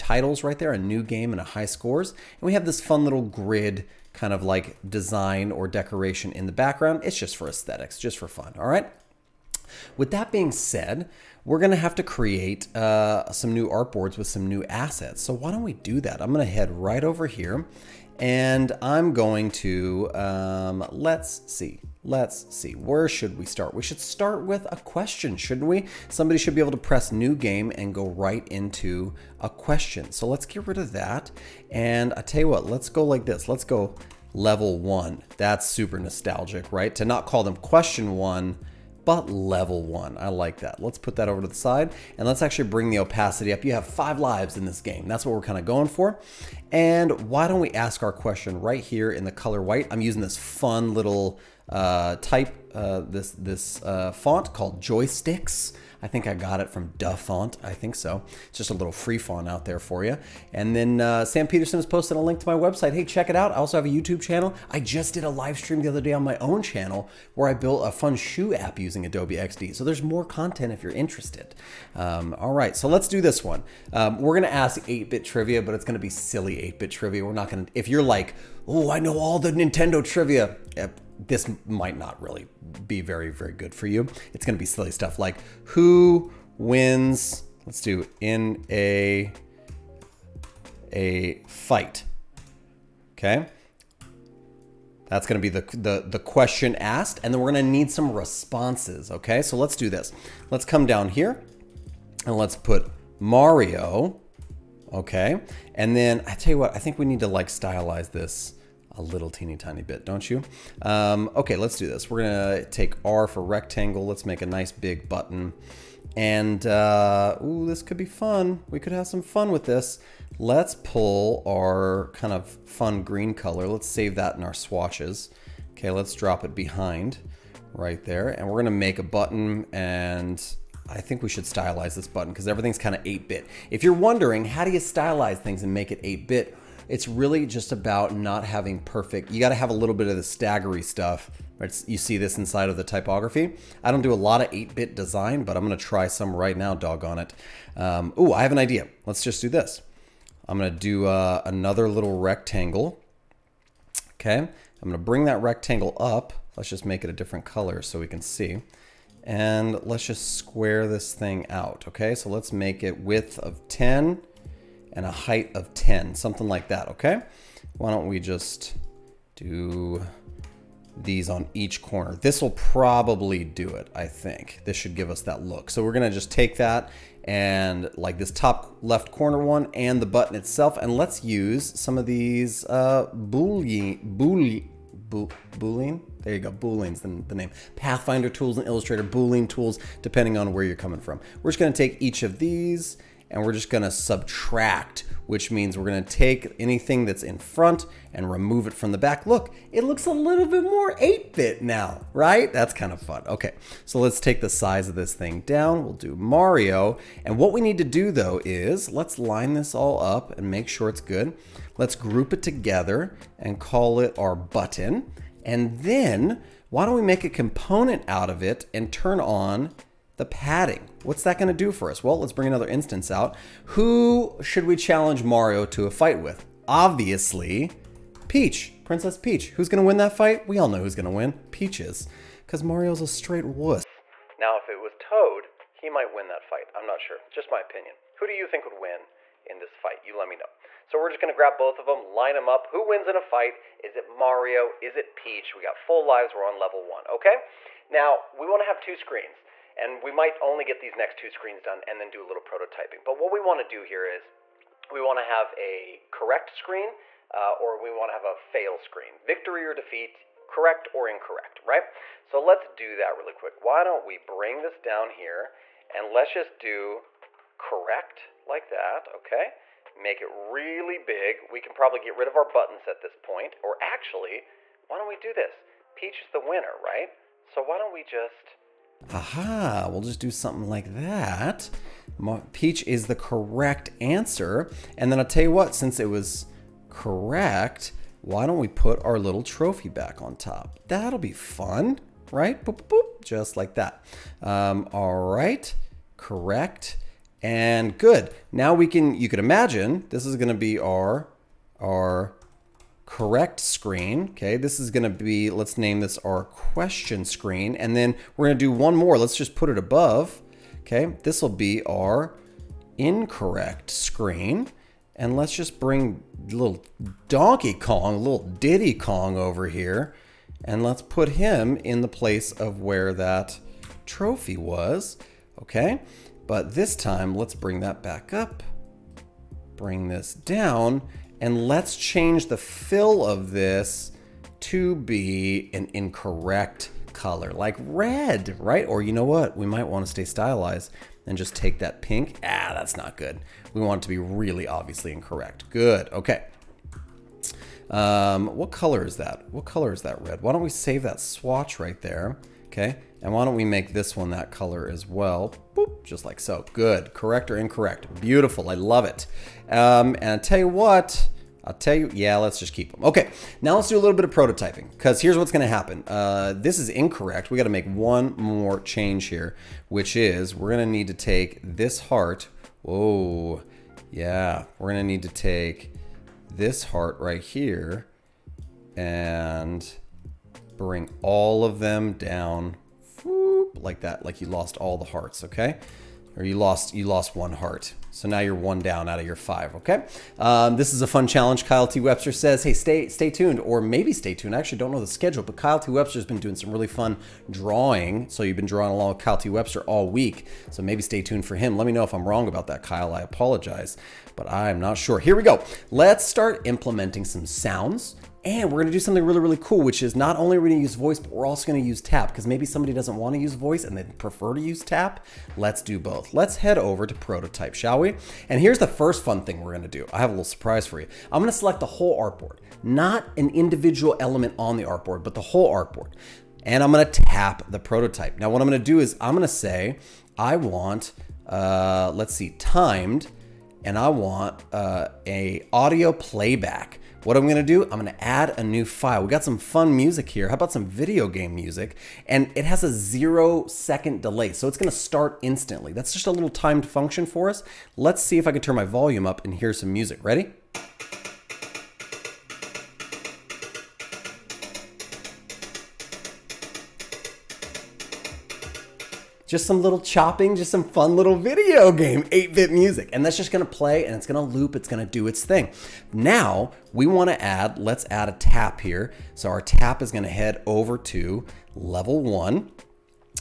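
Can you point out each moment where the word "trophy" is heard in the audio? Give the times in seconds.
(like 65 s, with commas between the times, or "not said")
289 s, 324 s.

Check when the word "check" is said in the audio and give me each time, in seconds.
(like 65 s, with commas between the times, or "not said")
63 s.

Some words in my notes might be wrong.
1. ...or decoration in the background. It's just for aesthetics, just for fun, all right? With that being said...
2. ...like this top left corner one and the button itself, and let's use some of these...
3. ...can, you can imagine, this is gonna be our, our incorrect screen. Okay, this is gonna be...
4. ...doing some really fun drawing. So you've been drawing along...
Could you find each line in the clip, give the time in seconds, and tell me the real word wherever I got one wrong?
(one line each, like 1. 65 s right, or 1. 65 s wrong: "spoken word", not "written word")
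1. 5 s right
2. 177 s right
3. 298 s wrong: "correct", not "incorrect"
4. 396 s right.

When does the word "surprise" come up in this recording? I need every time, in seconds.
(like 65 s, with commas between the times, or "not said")
420 s.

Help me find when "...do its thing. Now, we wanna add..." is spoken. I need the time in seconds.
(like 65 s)
465 s.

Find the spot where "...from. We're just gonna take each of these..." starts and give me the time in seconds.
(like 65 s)
191 s.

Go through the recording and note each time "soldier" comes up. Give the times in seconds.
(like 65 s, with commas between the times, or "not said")
not said.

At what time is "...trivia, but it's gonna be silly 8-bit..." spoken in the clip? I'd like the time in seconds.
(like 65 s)
75 s.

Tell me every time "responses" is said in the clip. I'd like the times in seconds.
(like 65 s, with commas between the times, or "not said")
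98 s.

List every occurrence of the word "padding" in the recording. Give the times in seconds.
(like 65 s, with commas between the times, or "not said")
220 s.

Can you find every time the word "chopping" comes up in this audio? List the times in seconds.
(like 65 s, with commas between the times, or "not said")
460 s.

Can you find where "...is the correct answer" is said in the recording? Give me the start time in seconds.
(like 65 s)
282 s.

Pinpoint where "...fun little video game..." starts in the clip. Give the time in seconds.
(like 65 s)
460 s.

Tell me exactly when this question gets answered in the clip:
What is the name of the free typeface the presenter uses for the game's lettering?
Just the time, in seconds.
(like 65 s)
54 s.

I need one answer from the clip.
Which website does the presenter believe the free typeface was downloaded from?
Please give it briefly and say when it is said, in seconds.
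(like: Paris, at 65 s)
Dafont, at 56 s.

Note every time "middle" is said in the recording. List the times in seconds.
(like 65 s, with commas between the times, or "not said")
not said.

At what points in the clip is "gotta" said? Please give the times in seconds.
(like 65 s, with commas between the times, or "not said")
139 s, 367 s.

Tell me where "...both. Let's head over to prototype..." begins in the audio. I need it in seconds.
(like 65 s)
415 s.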